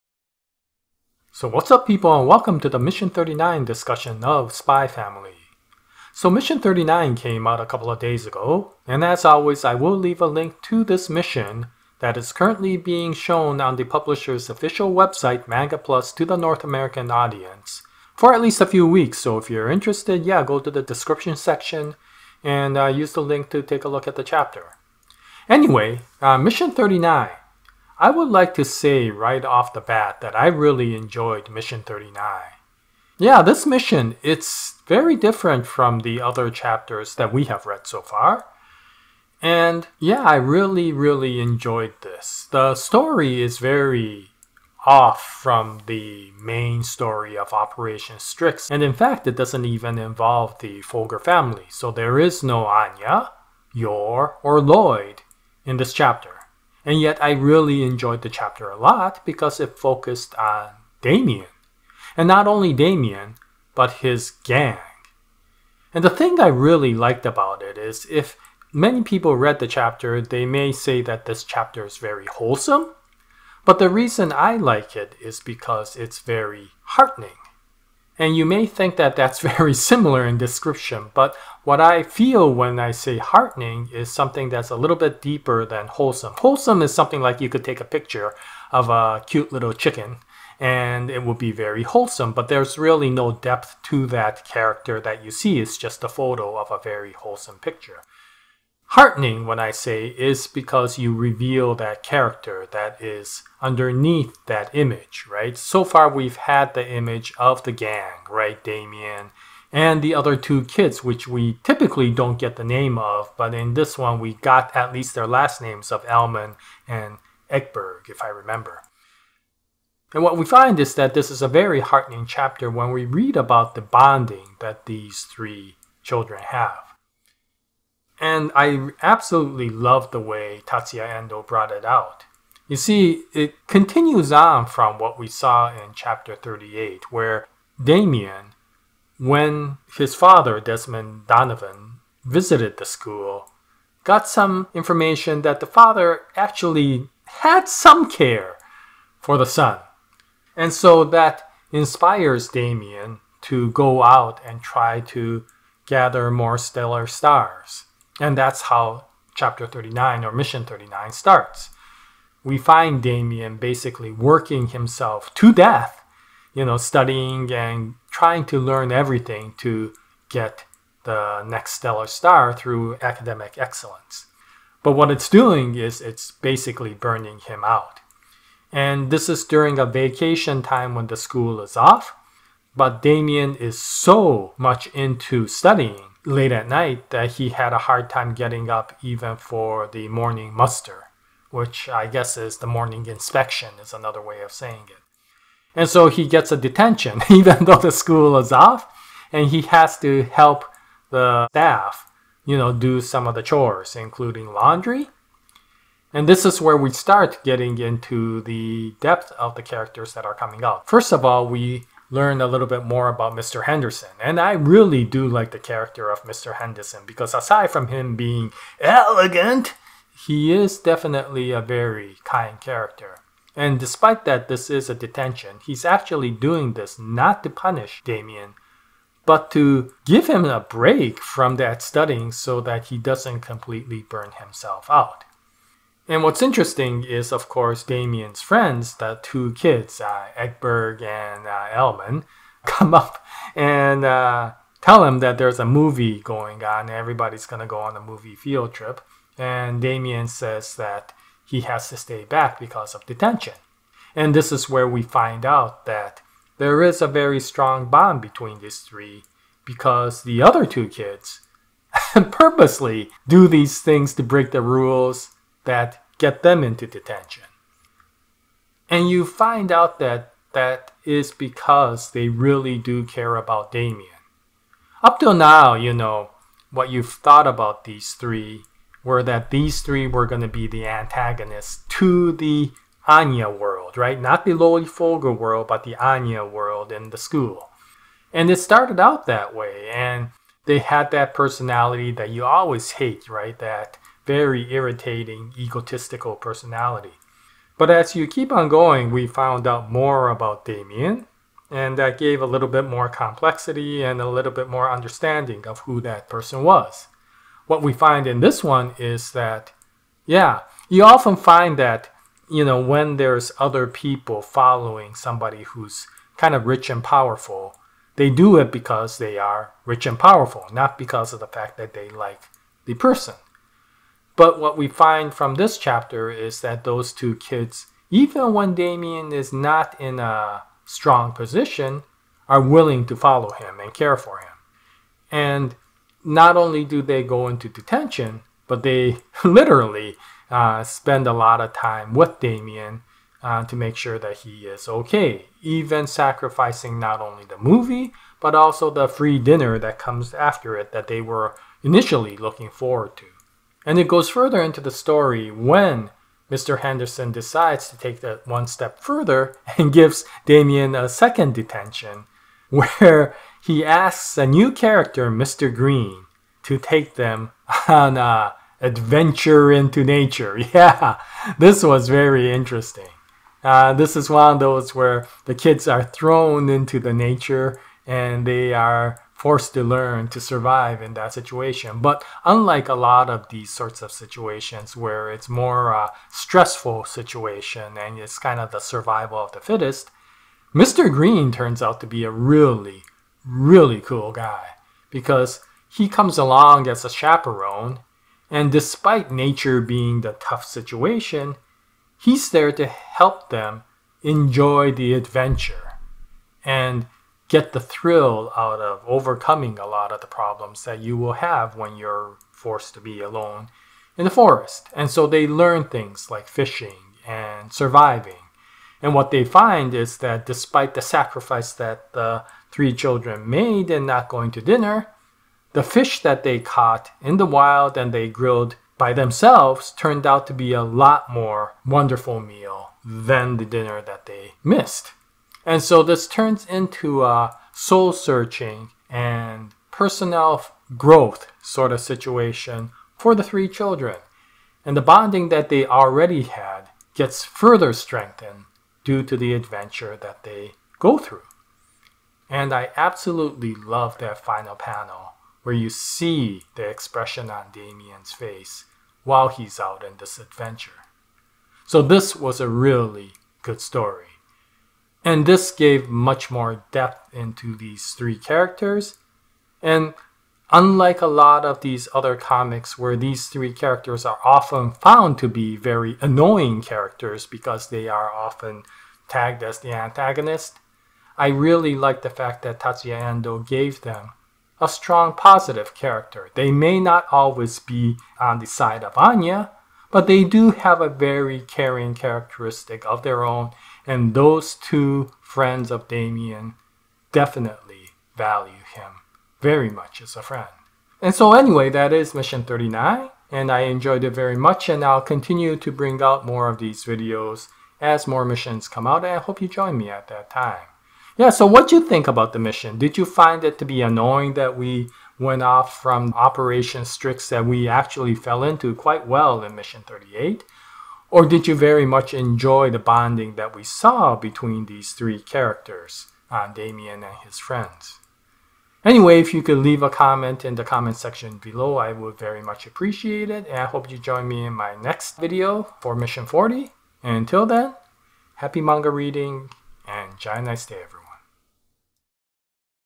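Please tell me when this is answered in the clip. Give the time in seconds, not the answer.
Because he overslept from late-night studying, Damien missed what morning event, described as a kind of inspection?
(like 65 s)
190 s.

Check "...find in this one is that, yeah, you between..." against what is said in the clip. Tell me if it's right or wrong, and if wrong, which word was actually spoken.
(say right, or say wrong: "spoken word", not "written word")
wrong: "often", not "between".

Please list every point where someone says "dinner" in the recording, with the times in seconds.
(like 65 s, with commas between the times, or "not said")
349 s, 424 s, 433 s.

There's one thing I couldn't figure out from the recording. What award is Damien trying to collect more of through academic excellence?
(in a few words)
stellar stars.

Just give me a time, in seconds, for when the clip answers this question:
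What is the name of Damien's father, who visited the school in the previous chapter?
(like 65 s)
140 s.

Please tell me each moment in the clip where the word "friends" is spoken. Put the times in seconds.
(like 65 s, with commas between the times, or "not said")
238 s, 495 s, 500 s, 527 s.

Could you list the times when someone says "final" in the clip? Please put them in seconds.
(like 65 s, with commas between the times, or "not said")
454 s.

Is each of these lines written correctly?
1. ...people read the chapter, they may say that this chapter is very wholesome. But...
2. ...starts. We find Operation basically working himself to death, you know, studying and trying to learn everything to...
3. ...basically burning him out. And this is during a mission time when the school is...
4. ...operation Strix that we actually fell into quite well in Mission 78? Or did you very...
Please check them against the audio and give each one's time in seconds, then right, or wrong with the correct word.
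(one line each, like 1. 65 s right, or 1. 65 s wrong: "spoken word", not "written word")
1. 69 s right
2. 161 s wrong: "Damien", not "Operation"
3. 176 s wrong: "vacation", not "mission"
4. 516 s wrong: "38", not "78".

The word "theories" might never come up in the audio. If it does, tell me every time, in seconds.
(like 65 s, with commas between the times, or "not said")
not said.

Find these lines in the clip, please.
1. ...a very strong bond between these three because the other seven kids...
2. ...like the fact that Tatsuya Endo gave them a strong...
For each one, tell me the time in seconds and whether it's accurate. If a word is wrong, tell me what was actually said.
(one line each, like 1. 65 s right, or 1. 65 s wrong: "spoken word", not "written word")
1. 257 s wrong: "two", not "seven"
2. 481 s right.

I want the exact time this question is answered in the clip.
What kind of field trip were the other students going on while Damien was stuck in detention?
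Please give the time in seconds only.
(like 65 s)
248 s.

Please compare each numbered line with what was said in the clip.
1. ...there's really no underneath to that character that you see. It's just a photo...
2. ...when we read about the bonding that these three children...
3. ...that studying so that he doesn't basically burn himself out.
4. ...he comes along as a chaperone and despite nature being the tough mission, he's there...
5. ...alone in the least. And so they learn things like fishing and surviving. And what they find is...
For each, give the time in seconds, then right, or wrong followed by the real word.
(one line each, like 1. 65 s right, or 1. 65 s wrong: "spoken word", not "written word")
1. 92 s wrong: "depth", not "underneath"
2. 122 s right
3. 231 s wrong: "completely", not "basically"
4. 395 s wrong: "situation", not "mission"
5. 413 s wrong: "forest", not "least".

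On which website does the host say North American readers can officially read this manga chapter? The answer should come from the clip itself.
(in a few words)
Manga Plus.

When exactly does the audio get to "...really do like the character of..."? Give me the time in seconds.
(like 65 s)
214 s.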